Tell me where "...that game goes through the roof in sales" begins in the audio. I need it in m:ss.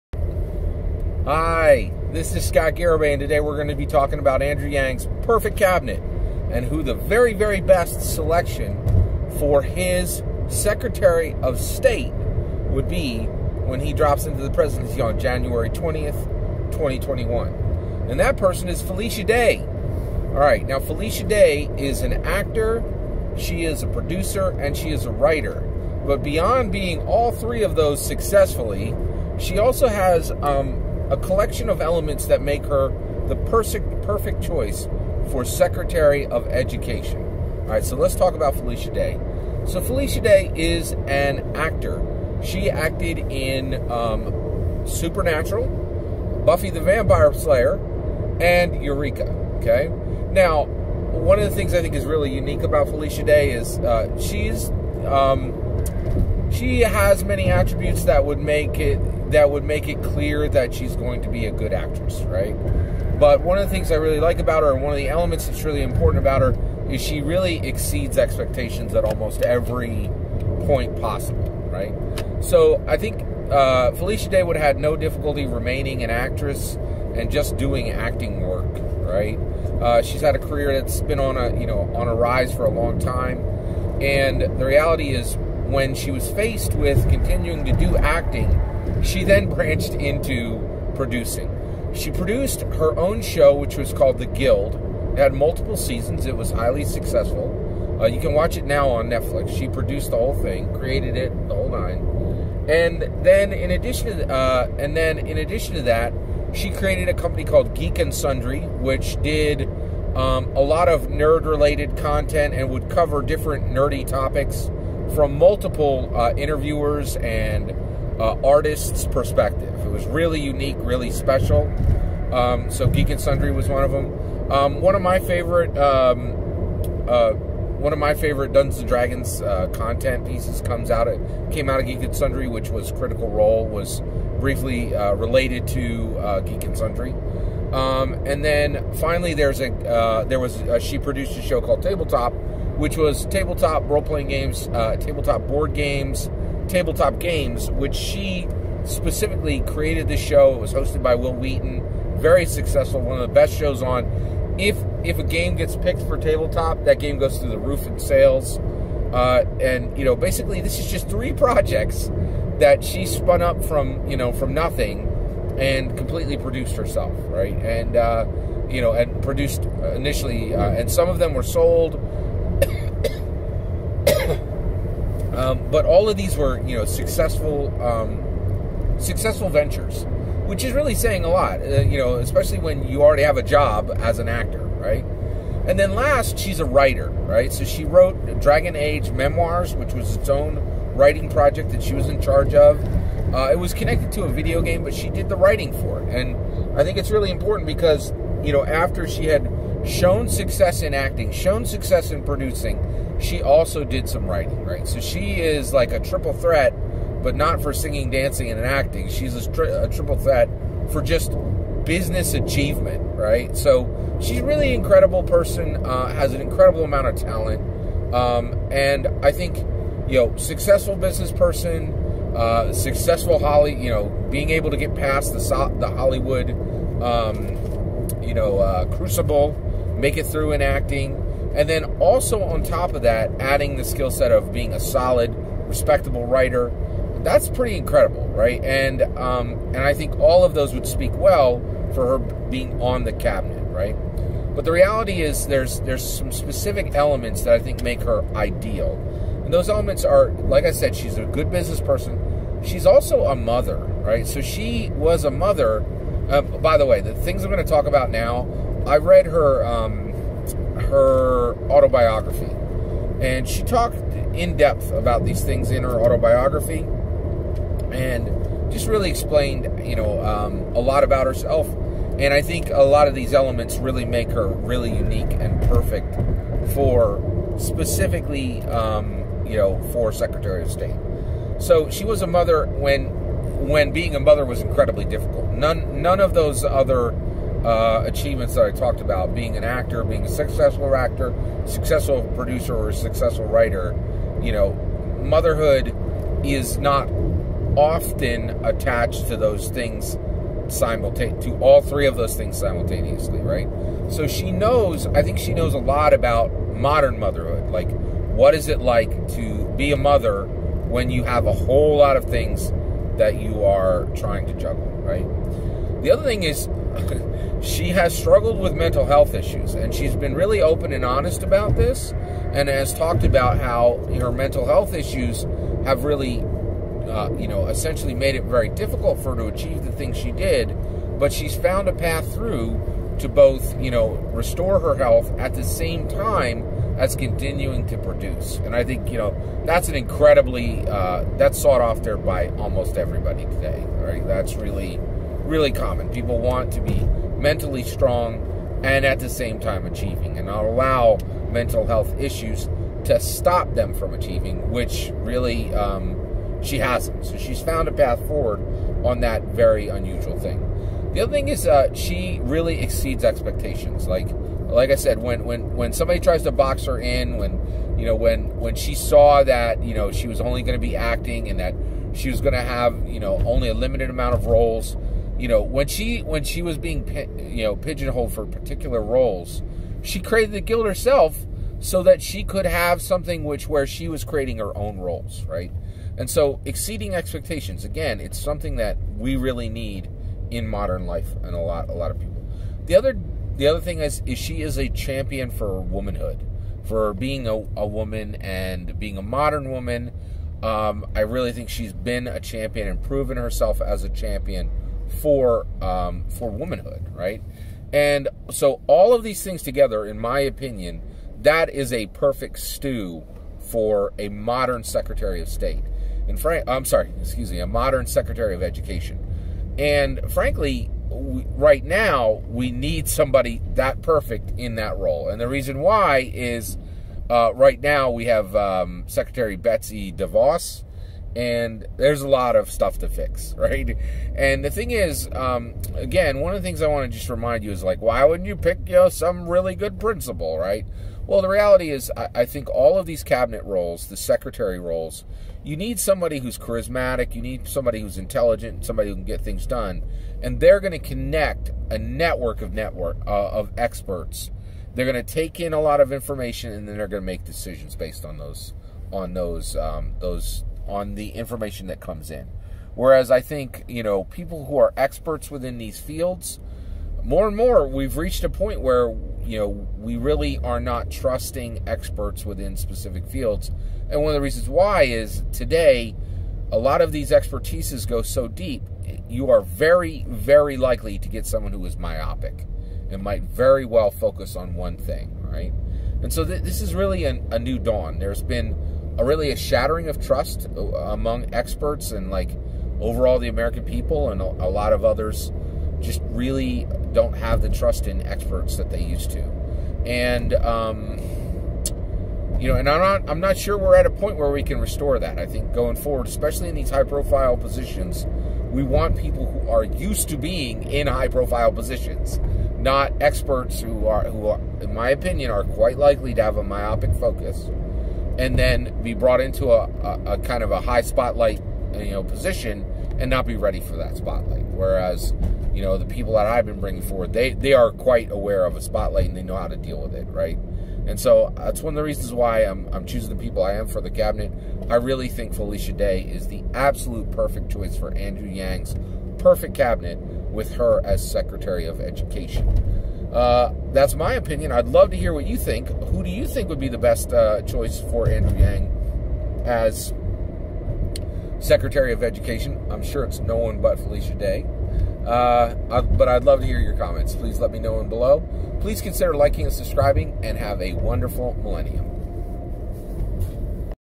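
2:36.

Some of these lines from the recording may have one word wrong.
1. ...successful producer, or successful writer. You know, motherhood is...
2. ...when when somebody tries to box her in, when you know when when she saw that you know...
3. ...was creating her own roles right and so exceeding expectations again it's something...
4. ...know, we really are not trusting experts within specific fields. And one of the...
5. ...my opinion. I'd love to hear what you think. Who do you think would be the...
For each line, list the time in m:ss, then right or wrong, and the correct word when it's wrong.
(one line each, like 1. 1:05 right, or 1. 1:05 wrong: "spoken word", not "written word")
1. 4:51 right
2. 6:05 right
3. 6:24 right
4. 7:49 right
5. 9:04 right.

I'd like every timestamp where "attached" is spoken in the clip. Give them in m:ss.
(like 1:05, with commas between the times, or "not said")
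4:58.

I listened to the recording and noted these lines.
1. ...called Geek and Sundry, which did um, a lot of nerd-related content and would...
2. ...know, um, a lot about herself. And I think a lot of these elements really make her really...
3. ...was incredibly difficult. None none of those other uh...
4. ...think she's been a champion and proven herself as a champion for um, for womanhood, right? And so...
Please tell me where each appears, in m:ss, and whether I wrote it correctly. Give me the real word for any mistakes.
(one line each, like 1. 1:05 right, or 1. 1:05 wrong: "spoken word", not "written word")
1. 1:47 right
2. 4:29 right
3. 4:44 right
4. 6:41 right.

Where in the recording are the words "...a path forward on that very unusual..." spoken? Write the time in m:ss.
5:57.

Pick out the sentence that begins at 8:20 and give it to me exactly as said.
And um, you know, and I'm not I'm not sure we're at a point where we can restore that.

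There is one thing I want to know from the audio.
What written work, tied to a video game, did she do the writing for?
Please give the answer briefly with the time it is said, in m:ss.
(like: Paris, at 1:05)
Dragon Age Memoirs, at 3:08.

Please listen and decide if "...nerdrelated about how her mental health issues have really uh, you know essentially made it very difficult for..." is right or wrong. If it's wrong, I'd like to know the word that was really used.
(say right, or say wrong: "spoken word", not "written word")
wrong: "talked", not "nerdrelated".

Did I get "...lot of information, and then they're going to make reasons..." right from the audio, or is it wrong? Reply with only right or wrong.
wrong.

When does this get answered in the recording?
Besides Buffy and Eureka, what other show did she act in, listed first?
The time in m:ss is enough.
0:44.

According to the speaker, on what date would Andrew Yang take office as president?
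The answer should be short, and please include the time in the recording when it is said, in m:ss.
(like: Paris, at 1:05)
January 20th, 2021, at 0:15.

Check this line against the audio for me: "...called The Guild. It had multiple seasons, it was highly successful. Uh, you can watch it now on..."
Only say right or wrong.
right.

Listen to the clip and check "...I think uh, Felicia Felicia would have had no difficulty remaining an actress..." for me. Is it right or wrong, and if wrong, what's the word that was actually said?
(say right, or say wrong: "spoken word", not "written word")
wrong: "Day", not "Felicia".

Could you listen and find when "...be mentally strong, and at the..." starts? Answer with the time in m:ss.
5:46.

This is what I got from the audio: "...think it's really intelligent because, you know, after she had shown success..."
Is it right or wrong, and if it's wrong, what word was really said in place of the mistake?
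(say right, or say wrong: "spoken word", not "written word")
wrong: "important", not "intelligent".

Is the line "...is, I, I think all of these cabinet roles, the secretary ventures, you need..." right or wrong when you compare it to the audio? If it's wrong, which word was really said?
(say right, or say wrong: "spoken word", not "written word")
wrong: "roles", not "ventures".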